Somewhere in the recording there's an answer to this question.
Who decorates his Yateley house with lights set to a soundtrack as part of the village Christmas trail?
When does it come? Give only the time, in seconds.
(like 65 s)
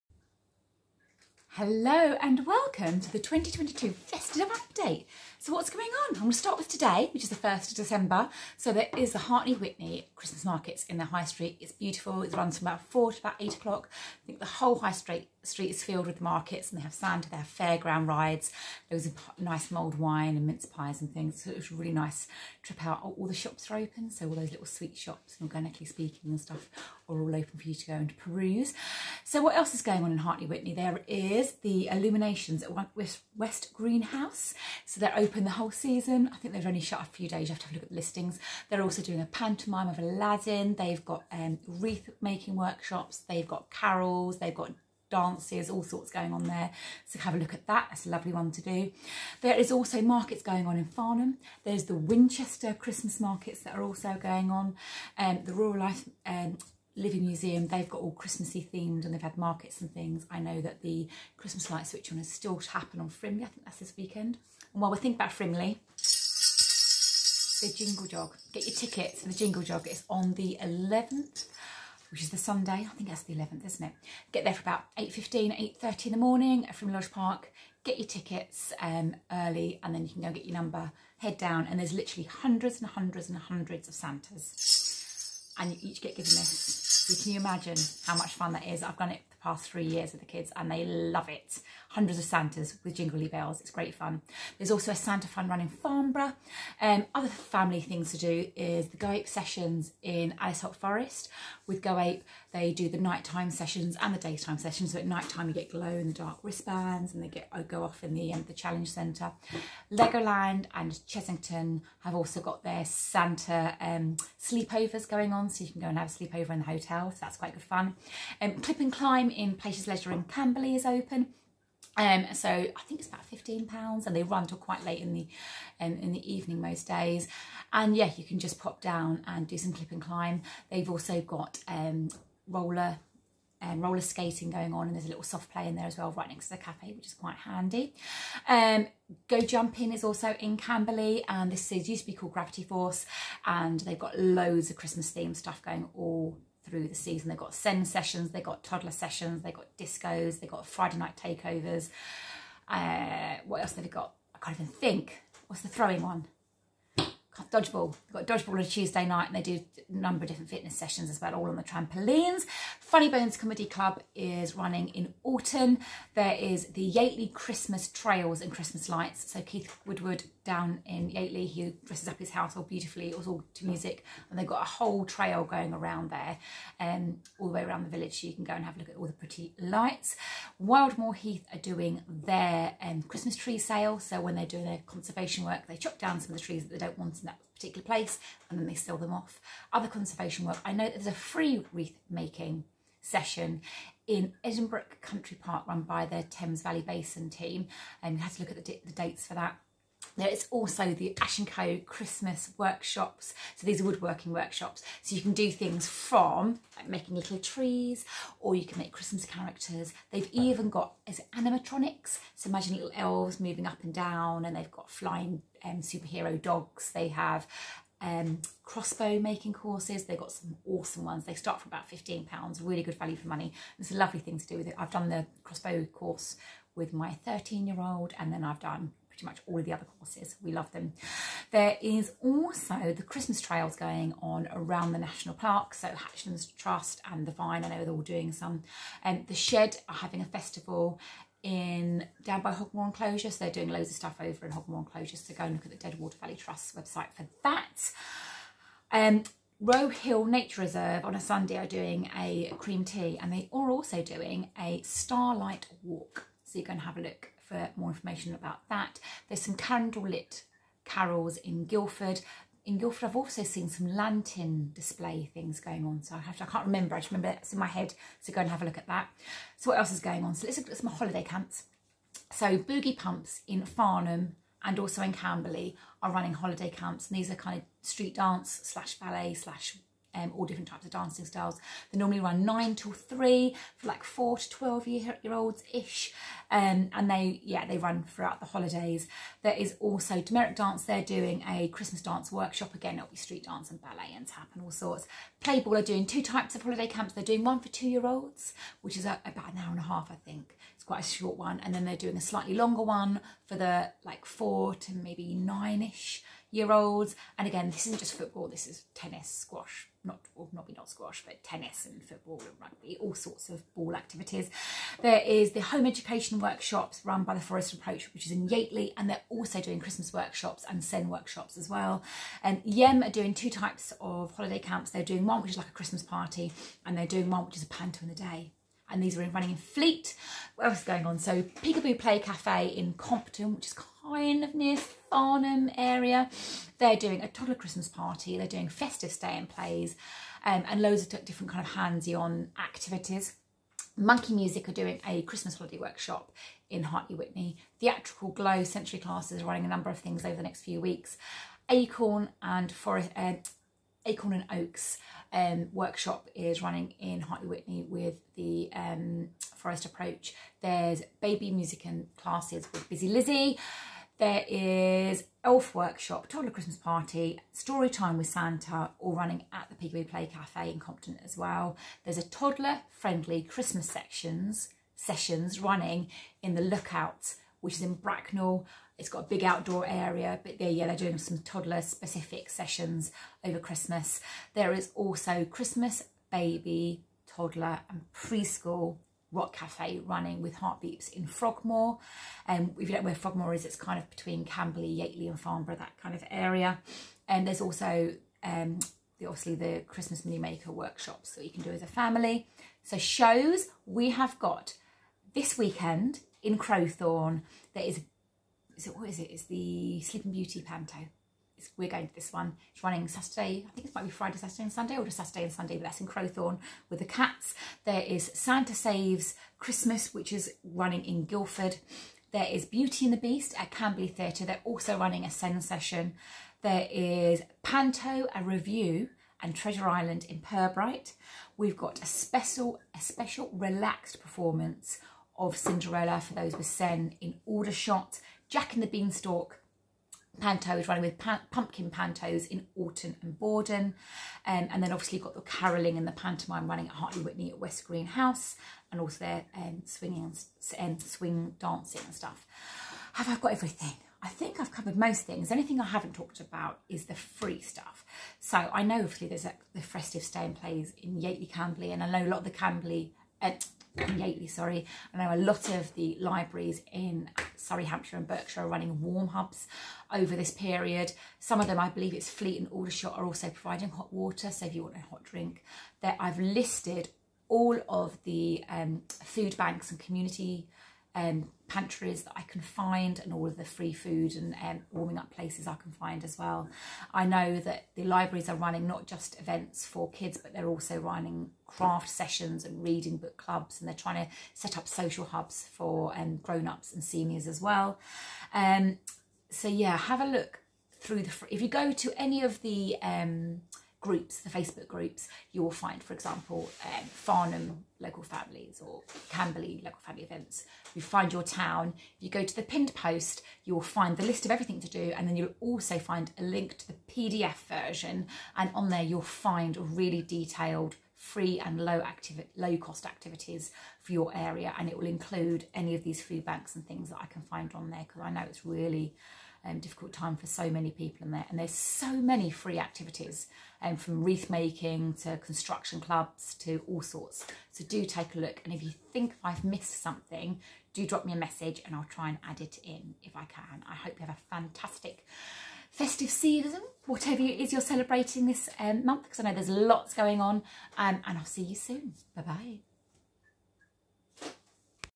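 169 s.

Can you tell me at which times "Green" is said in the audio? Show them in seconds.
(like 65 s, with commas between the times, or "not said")
33 s, 447 s.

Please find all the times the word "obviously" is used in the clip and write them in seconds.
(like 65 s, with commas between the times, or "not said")
399 s, 444 s, 458 s.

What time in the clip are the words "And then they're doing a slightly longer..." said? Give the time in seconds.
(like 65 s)
301 s.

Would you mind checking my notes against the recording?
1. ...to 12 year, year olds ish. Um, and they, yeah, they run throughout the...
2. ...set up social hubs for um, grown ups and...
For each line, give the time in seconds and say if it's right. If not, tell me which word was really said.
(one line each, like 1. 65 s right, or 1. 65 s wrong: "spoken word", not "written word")
1. 284 s right
2. 494 s right.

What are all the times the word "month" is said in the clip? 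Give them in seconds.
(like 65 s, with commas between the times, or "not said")
549 s.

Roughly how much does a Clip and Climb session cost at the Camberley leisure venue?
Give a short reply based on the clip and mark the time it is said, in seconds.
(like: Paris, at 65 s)
£15, at 123 s.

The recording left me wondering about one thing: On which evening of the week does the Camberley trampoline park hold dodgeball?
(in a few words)
Tuesday.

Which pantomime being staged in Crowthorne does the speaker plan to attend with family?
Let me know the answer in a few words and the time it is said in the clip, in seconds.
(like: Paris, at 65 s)
Sleeping Beauty, at 410 s.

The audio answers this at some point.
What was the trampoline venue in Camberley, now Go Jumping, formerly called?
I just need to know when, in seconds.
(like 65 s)
142 s.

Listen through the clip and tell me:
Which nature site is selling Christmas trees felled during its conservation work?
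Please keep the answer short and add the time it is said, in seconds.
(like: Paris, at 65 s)
Wildmoor Heath, at 180 s.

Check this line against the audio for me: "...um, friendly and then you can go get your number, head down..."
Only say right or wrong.
wrong.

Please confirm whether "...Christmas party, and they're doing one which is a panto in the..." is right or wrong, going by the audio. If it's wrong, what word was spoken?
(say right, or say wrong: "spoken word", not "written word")
right.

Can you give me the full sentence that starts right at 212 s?
So imagine little elves moving up and down and they've got flying um, superhero dogs.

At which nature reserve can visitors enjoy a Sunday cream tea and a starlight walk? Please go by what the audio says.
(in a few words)
Row Hill Nature Reserve.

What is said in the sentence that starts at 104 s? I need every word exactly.
So at nighttime, you get glow in the dark wristbands and they get go off in the, um, the challenge centre.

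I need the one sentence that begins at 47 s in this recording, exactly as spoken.
That's a lovely one to do.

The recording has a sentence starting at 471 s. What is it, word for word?
Some of them, I believe it's Fleet and Aldershot, are also providing hot water.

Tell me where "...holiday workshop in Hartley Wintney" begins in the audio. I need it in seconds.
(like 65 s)
345 s.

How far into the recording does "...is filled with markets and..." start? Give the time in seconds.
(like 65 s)
15 s.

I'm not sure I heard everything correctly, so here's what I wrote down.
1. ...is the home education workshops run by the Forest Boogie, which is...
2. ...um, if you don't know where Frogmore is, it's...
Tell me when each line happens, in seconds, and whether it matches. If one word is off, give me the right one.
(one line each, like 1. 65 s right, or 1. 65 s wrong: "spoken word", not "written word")
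1. 315 s wrong: "Approach", not "Boogie"
2. 392 s right.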